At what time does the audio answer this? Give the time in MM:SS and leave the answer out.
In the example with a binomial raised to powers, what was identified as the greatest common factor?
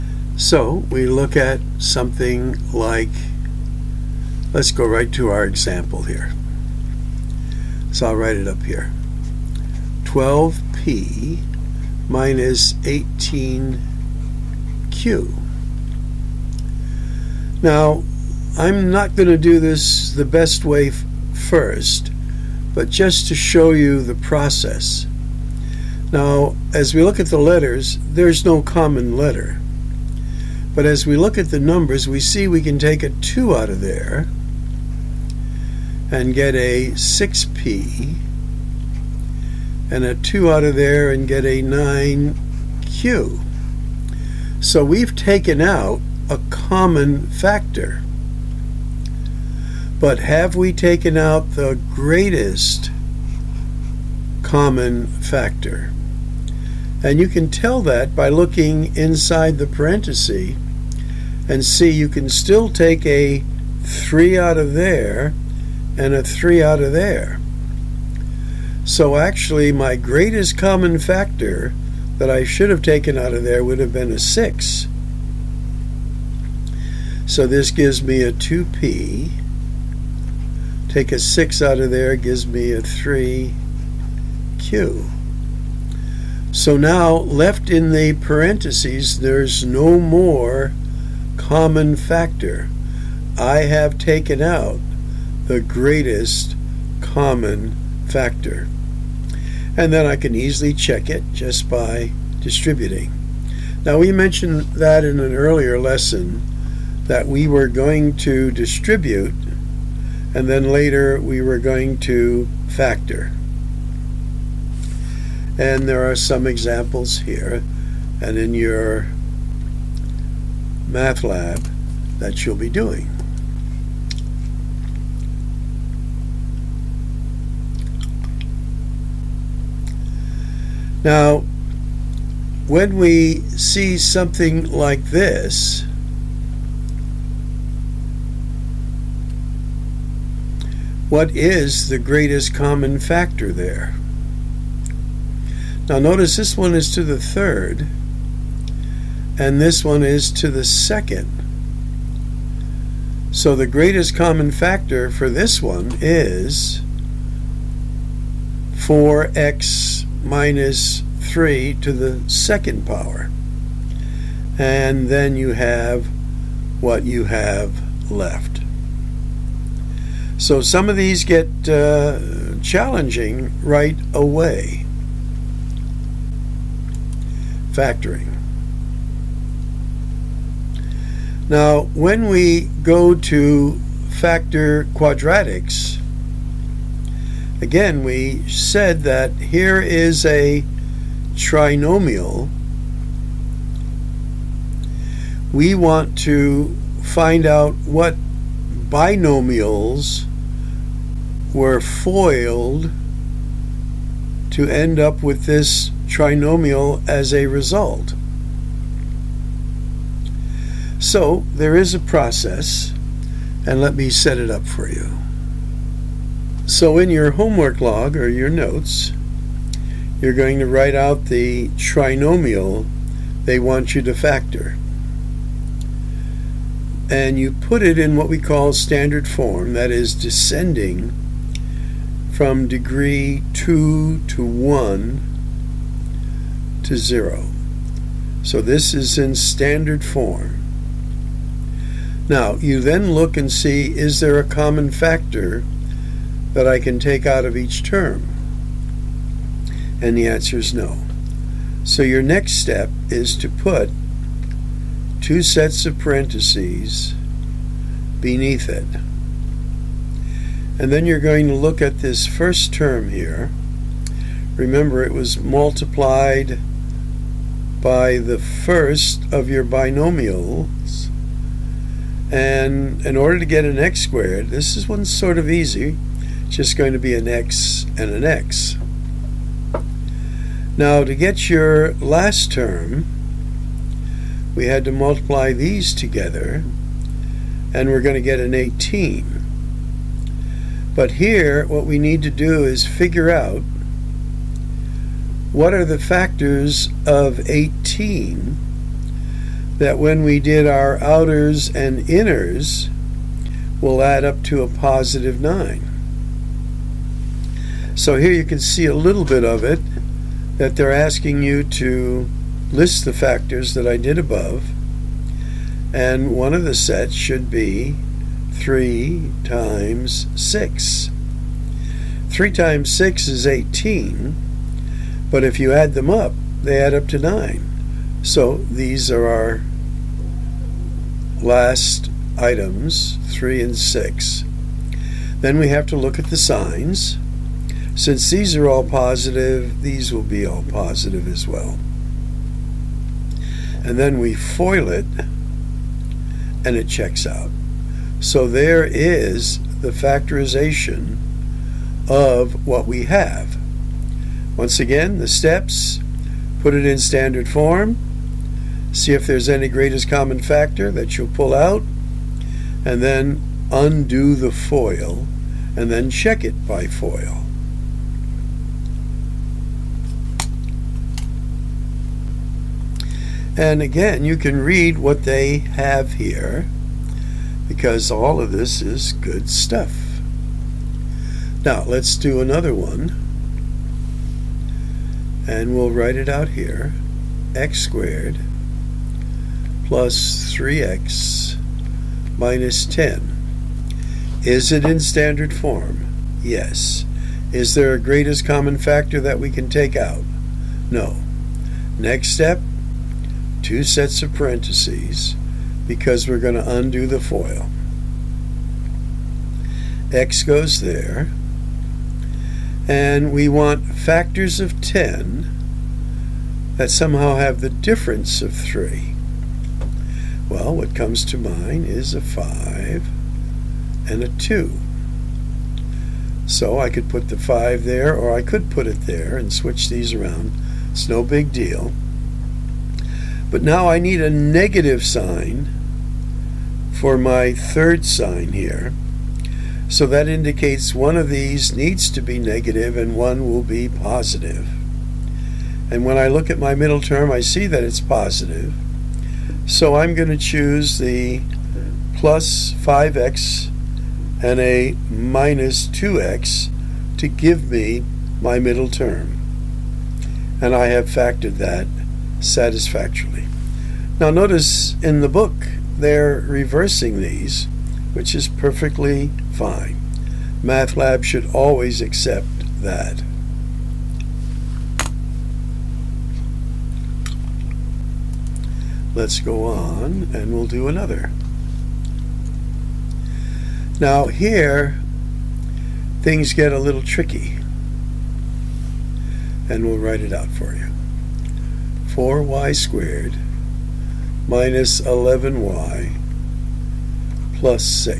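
02:38.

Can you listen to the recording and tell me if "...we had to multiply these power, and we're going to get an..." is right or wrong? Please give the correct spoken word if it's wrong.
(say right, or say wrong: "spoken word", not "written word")
wrong: "together", not "power".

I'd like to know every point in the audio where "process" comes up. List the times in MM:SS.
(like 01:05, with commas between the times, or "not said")
00:24, 03:31.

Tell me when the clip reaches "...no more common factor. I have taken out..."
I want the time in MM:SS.
01:29.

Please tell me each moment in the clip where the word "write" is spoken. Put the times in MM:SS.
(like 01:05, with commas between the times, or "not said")
00:08, 03:40, 06:25, 08:09.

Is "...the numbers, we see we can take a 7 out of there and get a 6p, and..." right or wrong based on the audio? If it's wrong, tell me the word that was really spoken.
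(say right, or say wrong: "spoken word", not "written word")
wrong: "2", not "7".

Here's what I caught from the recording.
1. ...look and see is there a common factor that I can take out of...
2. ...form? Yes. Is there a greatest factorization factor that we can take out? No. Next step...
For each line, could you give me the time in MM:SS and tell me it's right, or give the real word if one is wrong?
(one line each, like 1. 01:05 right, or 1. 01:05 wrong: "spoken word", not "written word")
1. 04:03 right
2. 06:35 wrong: "common", not "factorization".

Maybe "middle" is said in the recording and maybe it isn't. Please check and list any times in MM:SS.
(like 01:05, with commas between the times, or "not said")
07:26, 07:38.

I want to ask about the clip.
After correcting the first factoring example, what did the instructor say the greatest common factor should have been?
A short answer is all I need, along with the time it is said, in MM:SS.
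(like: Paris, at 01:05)
6, at 01:13.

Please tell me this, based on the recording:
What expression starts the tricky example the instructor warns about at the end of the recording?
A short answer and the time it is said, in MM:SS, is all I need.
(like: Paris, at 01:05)
4y squared minus 11y, at 08:12.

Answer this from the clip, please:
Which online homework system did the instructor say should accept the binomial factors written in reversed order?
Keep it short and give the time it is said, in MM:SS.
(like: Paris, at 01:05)
MathLab, at 07:50.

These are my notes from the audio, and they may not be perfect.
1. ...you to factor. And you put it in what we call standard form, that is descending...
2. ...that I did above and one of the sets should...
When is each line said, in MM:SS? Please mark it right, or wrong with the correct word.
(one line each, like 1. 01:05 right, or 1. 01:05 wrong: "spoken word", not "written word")
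1. 03:43 right
2. 05:13 right.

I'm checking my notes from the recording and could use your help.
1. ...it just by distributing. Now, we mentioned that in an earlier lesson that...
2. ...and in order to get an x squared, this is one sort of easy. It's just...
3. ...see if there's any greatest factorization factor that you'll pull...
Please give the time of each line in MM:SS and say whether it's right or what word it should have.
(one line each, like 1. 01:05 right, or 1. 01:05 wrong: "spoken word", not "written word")
1. 01:41 right
2. 04:32 right
3. 05:58 wrong: "common", not "factorization".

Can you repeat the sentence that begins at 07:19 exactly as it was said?
So that indicates one of these needs to be negative and one will be positive.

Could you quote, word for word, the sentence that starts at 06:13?
And again, you can read what they have here because all of this is good stuff.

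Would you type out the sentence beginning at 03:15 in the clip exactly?
We want to find out what binomials were foiled to end up with this trinomial as a result.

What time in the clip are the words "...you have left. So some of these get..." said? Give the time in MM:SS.
02:47.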